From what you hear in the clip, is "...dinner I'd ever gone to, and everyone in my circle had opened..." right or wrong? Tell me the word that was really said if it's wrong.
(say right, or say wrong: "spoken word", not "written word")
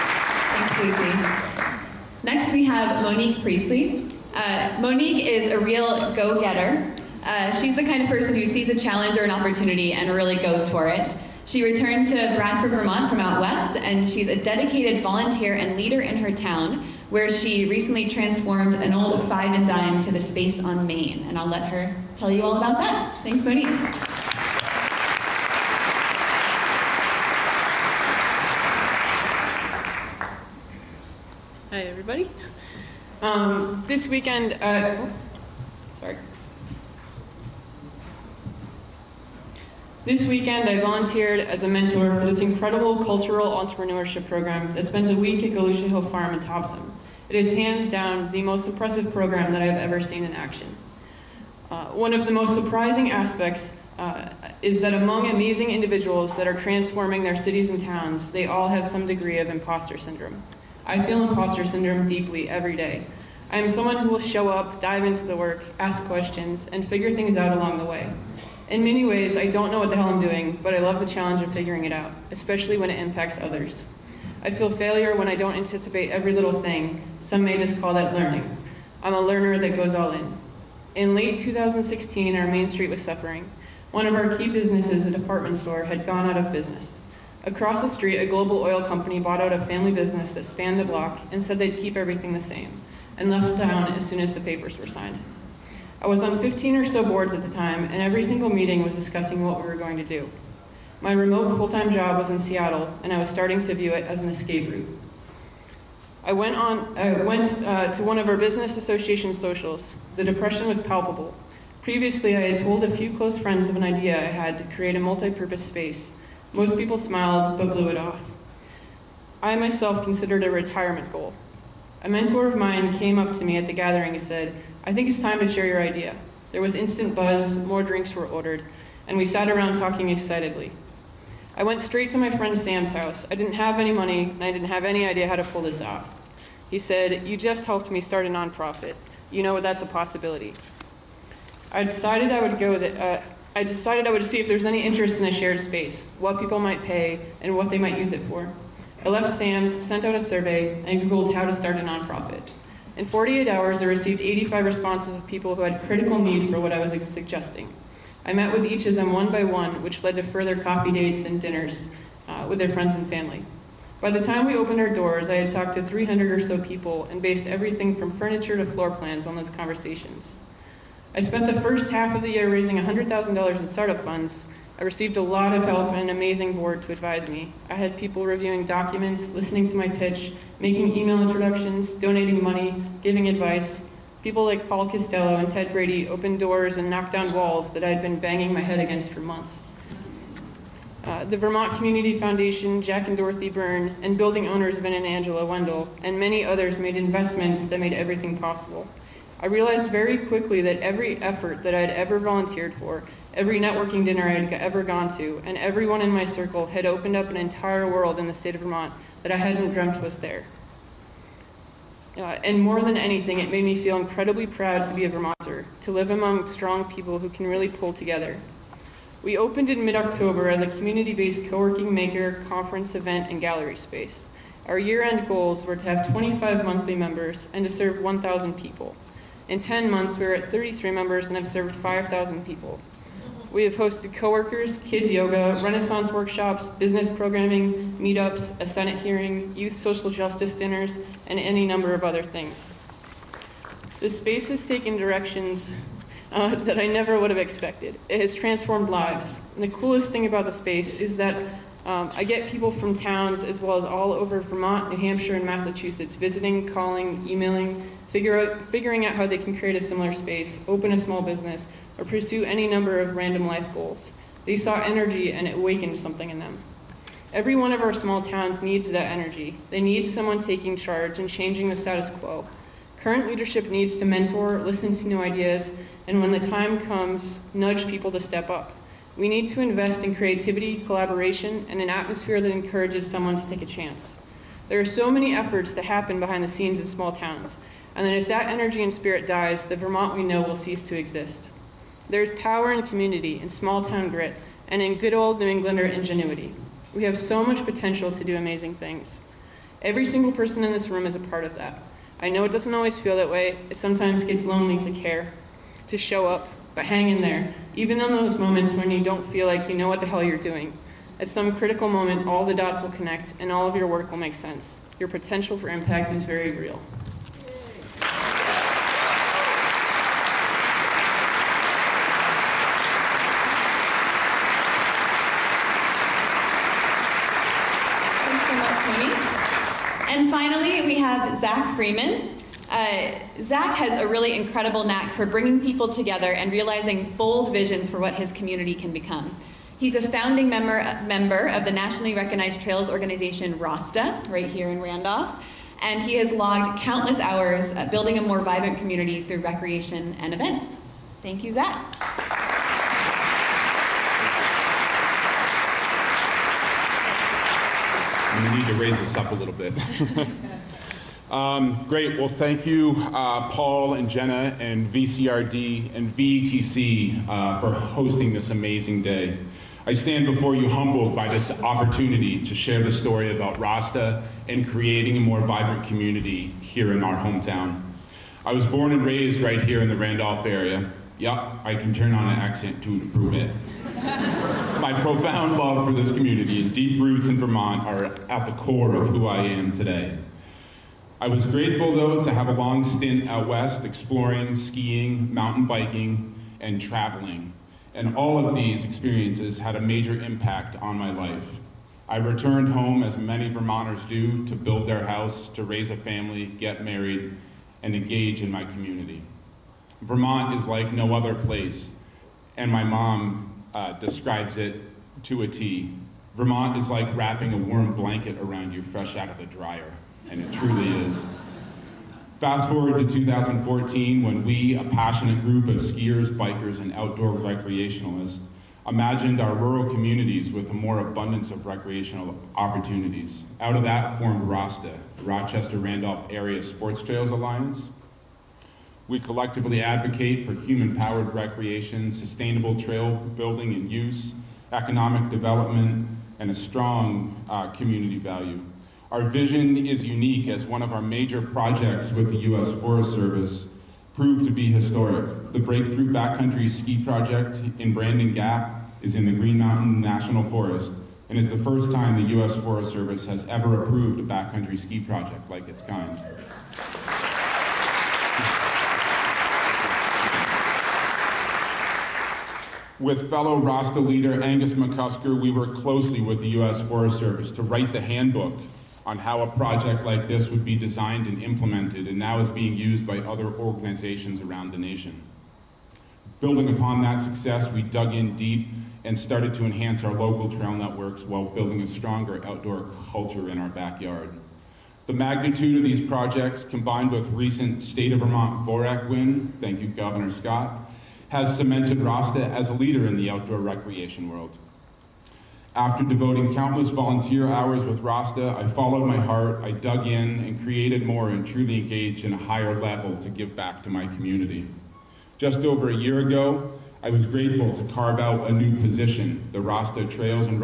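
right.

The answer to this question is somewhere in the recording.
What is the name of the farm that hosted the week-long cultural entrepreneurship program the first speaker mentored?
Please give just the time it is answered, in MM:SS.
00:45.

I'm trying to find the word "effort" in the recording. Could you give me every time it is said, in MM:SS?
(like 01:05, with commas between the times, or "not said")
03:21, 04:45.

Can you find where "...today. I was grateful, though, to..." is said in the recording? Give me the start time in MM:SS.
06:29.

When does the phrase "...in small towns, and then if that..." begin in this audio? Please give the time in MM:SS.
04:46.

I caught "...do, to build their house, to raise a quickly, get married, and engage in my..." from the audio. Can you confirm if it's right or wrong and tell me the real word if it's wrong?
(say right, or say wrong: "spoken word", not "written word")
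wrong: "family", not "quickly".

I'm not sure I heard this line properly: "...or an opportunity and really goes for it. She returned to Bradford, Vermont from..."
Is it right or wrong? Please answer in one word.
right.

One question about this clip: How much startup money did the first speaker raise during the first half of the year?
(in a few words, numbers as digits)
$100,000.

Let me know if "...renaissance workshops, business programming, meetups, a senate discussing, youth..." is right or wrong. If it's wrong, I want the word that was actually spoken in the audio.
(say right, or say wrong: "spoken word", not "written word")
wrong: "hearing", not "discussing".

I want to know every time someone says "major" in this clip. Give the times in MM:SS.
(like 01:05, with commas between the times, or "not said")
06:39, 07:31.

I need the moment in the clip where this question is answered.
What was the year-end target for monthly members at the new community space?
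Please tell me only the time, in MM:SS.
03:46.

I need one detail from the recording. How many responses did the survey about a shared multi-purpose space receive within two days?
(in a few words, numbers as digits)
85.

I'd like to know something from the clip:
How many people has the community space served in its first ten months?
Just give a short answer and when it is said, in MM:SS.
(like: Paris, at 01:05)
5,000, at 03:51.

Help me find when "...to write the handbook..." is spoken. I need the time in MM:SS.
07:57.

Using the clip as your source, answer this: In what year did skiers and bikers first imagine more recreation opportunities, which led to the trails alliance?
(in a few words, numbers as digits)
2014.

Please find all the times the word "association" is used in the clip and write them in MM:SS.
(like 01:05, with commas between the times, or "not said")
01:48.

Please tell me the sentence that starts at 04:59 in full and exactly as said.
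Every single person in this room is a part of that.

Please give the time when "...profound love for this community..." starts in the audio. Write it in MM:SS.
06:25.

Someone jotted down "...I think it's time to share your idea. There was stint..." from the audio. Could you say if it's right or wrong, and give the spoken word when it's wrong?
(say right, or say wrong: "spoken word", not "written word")
wrong: "instant", not "stint".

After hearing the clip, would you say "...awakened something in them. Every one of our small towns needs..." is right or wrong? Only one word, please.
right.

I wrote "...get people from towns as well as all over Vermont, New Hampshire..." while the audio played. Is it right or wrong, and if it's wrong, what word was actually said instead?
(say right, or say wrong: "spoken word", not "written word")
right.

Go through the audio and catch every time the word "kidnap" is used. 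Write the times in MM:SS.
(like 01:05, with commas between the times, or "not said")
not said.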